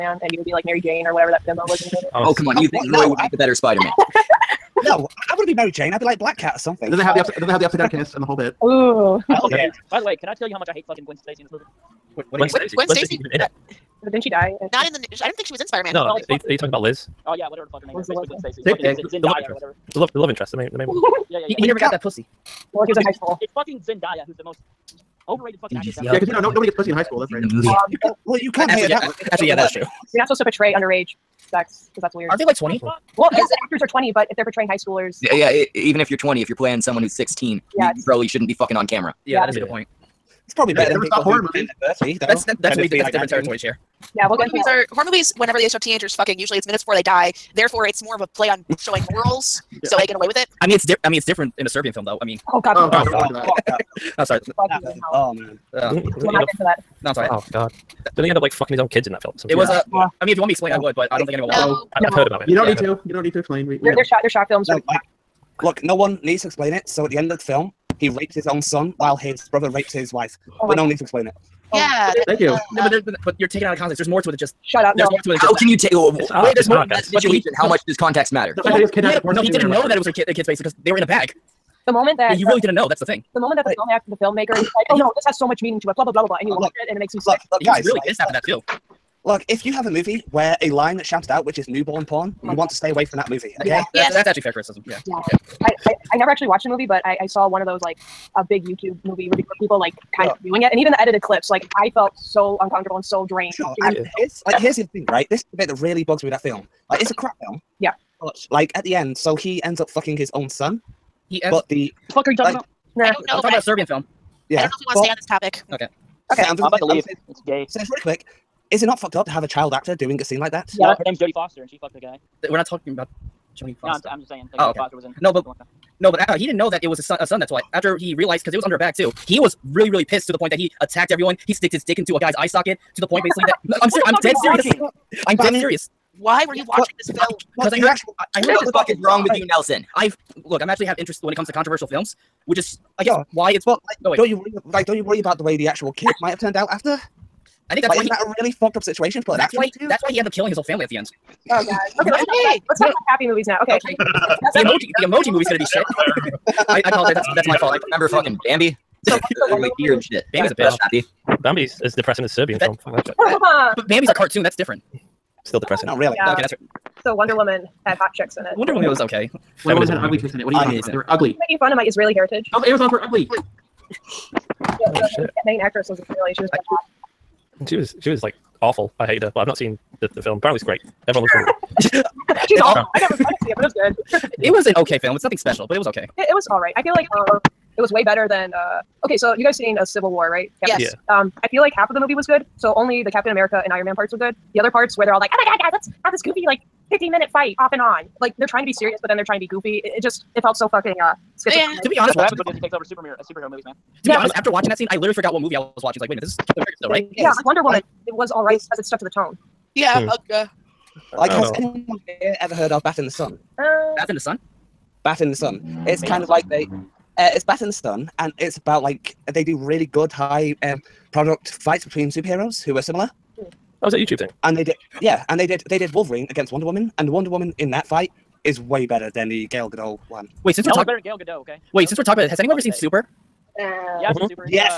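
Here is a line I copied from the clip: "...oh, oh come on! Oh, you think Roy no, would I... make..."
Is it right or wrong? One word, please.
right.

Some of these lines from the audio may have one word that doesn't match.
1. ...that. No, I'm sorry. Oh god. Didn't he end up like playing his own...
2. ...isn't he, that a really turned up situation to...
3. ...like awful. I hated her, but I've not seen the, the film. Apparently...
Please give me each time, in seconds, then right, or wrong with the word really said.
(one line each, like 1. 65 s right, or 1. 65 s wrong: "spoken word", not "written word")
1. 56 s wrong: "fucking", not "playing"
2. 148 s wrong: "fucked", not "turned"
3. 178 s right.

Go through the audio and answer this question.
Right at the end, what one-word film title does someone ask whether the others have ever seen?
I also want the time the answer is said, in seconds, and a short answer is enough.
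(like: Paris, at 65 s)
Super, at 232 s.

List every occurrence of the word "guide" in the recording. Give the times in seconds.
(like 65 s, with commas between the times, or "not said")
not said.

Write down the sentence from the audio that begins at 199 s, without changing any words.
It, it just it felt so fucking uh, schizophrenic.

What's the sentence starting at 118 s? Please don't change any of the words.
Is it not fucked up to have a child actor doing a scene like that?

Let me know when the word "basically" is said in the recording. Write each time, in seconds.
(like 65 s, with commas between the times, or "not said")
18 s, 133 s.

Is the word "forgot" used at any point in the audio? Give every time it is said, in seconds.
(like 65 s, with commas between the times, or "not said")
205 s.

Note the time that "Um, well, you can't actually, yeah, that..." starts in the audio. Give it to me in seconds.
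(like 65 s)
27 s.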